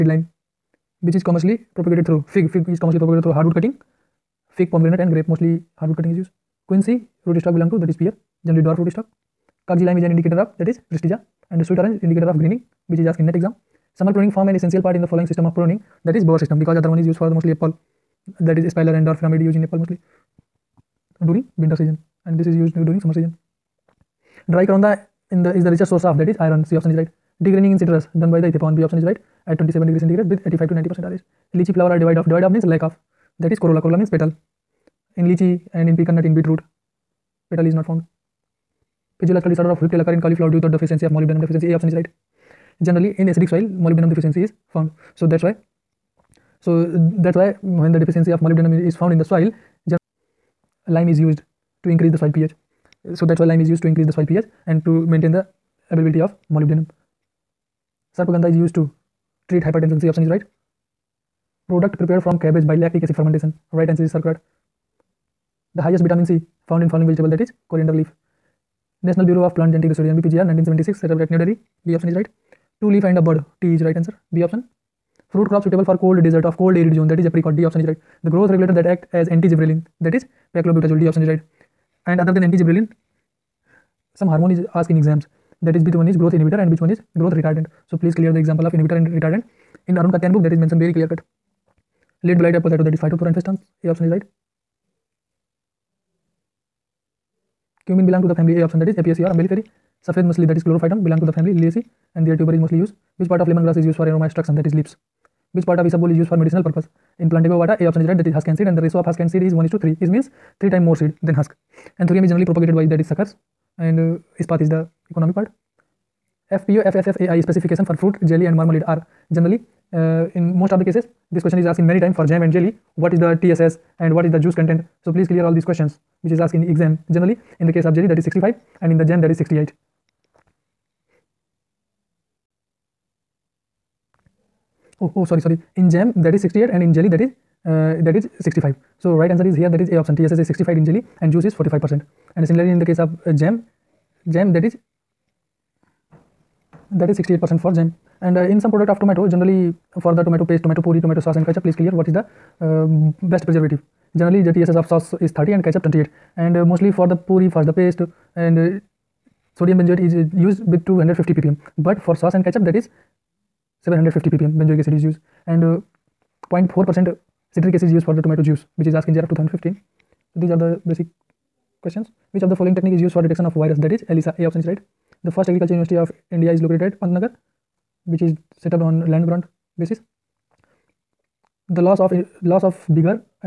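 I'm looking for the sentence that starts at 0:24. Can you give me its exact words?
Dry Karonda in the is the richest source of that is iron.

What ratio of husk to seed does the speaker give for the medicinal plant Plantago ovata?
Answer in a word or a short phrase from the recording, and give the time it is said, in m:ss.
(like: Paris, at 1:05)
1:3, at 1:49.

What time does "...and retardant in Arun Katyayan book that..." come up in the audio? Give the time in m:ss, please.
1:28.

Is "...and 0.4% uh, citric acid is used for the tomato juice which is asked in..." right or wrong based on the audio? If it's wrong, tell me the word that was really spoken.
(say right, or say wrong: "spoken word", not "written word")
right.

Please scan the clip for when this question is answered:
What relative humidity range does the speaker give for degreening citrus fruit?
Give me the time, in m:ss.
0:30.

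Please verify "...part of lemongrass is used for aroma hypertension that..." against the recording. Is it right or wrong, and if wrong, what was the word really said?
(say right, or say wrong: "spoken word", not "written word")
wrong: "extraction", not "hypertension".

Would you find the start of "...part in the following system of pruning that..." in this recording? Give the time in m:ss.
0:14.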